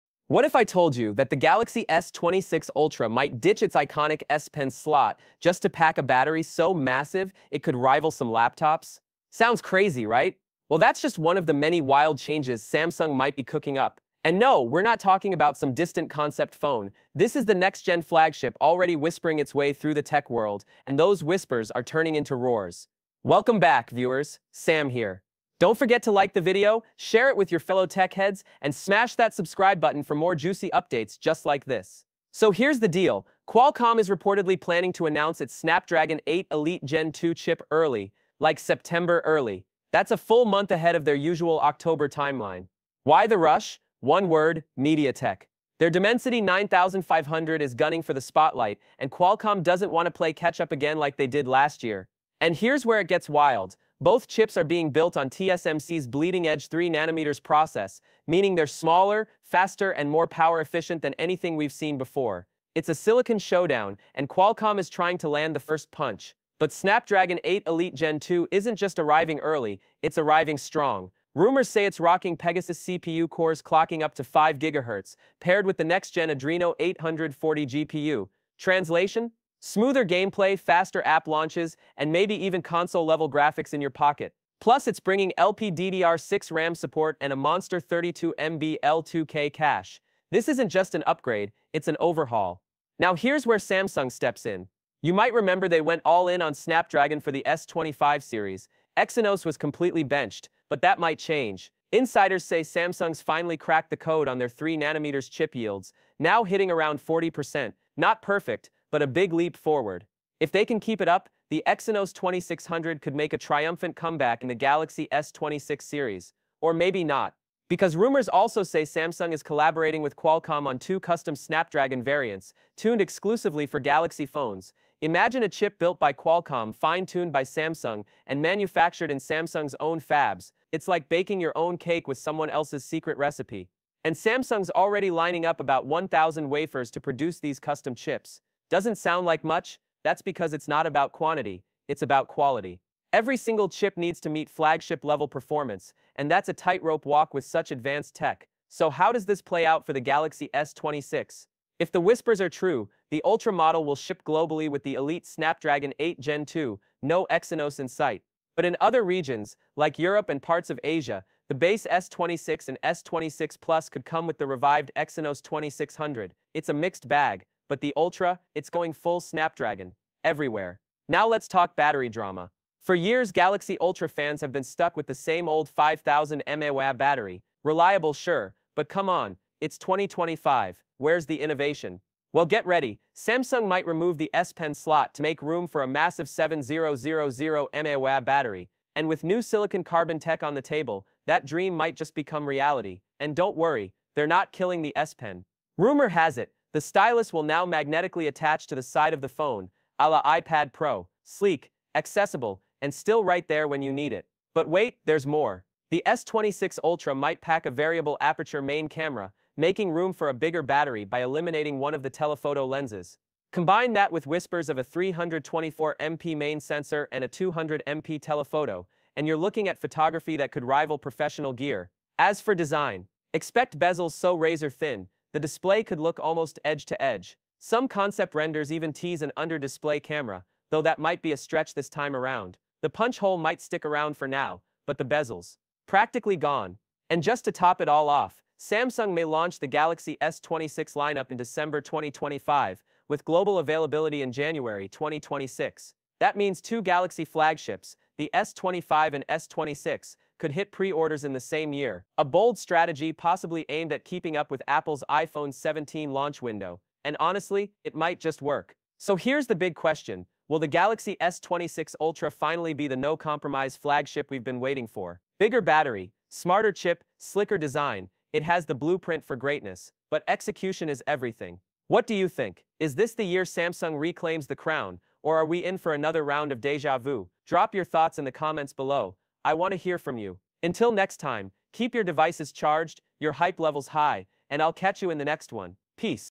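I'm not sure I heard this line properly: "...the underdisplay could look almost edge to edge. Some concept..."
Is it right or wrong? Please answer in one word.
wrong.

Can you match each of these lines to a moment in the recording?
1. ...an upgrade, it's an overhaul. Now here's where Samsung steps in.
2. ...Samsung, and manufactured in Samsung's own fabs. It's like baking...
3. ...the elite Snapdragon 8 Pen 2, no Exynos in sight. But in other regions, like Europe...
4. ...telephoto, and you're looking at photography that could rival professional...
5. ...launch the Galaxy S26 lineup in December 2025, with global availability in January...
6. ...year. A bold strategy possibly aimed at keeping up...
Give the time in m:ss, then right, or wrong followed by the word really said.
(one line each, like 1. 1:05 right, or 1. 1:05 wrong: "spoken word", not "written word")
1. 1:30 right
2. 2:07 right
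3. 2:34 wrong: "Gen", not "Pen"
4. 3:38 right
5. 3:59 right
6. 4:11 right.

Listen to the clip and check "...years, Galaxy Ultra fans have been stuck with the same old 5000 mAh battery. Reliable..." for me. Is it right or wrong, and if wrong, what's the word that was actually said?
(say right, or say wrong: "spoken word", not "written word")
right.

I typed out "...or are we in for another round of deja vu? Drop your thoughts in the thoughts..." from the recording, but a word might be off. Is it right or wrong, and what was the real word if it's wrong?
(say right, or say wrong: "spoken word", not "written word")
wrong: "comments", not "thoughts".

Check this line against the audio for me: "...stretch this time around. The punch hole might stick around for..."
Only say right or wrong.
right.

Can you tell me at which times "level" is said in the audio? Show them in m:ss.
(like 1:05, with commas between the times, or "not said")
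1:22, 2:25, 4:43.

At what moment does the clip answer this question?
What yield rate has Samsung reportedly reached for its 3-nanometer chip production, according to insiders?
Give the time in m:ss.
1:47.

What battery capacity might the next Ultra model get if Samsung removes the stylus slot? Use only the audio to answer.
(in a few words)
7000 mAh.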